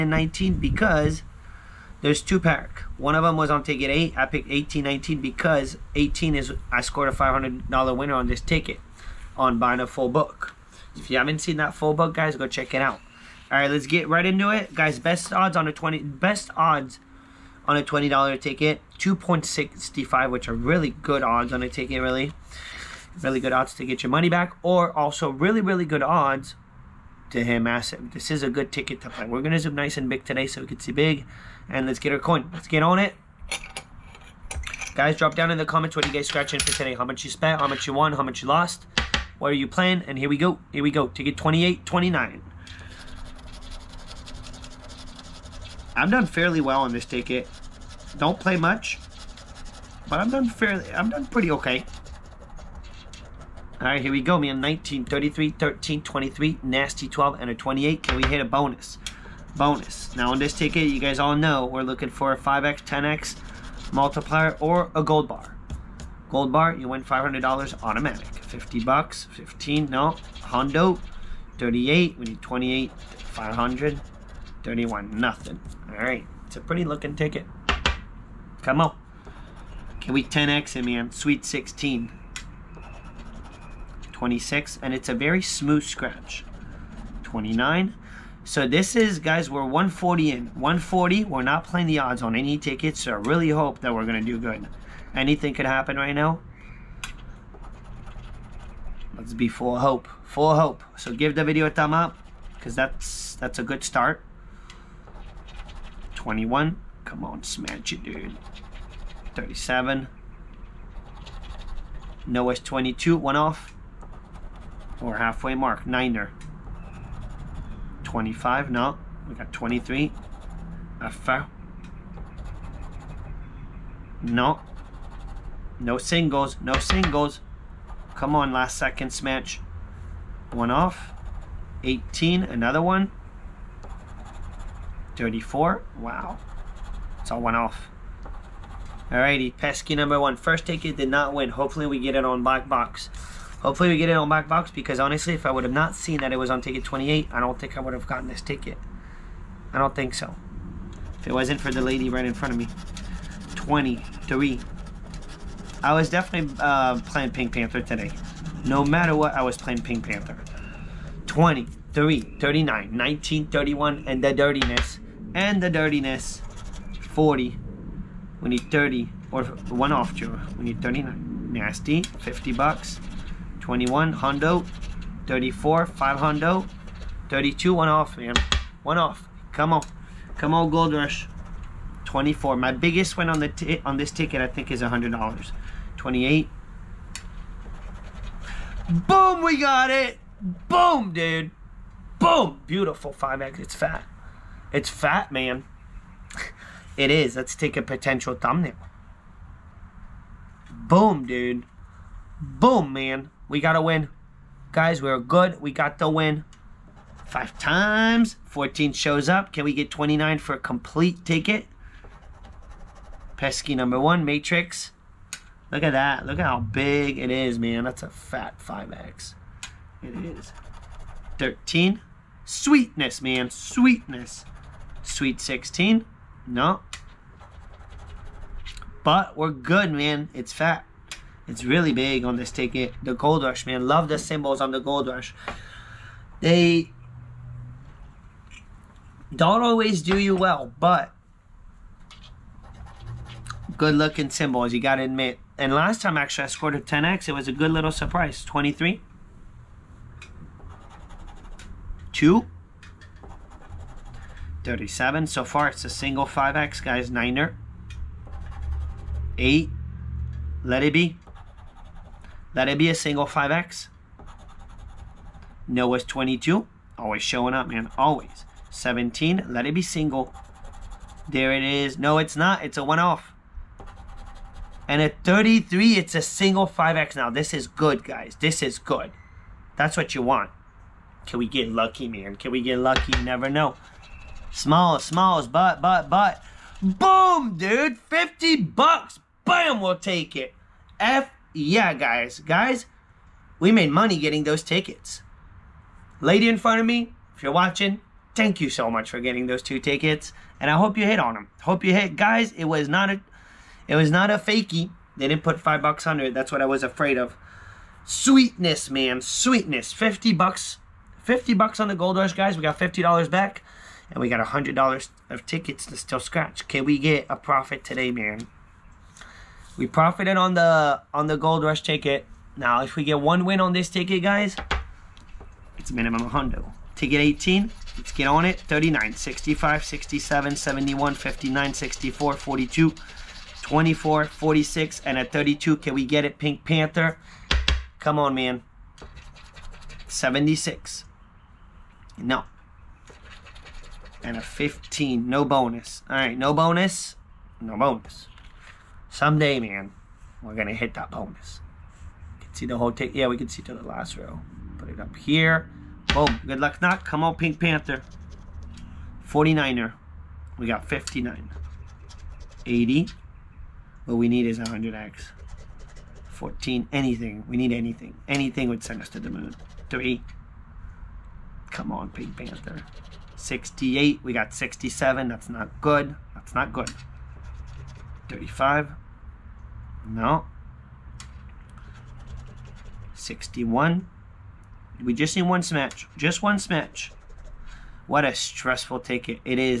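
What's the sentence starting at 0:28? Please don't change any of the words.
This is a good ticket to play.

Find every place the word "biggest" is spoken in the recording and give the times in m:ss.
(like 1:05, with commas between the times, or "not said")
3:02.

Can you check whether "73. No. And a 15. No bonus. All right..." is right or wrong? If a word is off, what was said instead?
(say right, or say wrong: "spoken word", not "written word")
wrong: "76", not "73".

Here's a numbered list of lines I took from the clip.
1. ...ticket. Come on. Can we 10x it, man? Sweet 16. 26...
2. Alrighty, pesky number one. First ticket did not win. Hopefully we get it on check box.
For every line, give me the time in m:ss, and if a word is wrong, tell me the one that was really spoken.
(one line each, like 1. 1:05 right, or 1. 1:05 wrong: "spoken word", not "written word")
1. 1:17 right
2. 2:19 wrong: "black", not "check".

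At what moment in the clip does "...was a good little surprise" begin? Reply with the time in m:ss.
4:07.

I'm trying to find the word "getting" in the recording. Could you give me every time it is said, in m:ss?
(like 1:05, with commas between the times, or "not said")
4:54, 4:59.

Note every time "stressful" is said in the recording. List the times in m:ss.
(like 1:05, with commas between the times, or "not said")
6:28.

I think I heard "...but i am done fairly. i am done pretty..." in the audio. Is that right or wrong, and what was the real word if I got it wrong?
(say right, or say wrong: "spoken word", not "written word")
right.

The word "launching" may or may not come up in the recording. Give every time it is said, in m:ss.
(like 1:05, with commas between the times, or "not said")
not said.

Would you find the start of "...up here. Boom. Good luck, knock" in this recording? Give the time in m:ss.
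5:55.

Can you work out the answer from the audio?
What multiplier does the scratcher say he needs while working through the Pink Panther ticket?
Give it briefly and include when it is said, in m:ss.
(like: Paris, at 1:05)
100x, at 6:04.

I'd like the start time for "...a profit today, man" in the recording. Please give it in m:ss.
5:17.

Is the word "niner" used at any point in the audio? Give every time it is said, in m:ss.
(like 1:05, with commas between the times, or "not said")
1:55, 4:17.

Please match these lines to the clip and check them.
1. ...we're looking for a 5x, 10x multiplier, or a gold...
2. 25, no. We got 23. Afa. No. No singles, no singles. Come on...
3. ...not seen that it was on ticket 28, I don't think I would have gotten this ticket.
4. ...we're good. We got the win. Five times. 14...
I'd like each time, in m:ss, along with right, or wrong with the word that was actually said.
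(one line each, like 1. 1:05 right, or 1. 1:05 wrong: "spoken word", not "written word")
1. 1:01 right
2. 1:58 right
3. 2:25 right
4. 3:25 right.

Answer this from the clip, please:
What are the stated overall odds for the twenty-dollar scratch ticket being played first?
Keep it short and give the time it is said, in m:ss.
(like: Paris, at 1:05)
2.65, at 0:18.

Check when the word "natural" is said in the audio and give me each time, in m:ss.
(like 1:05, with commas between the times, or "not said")
not said.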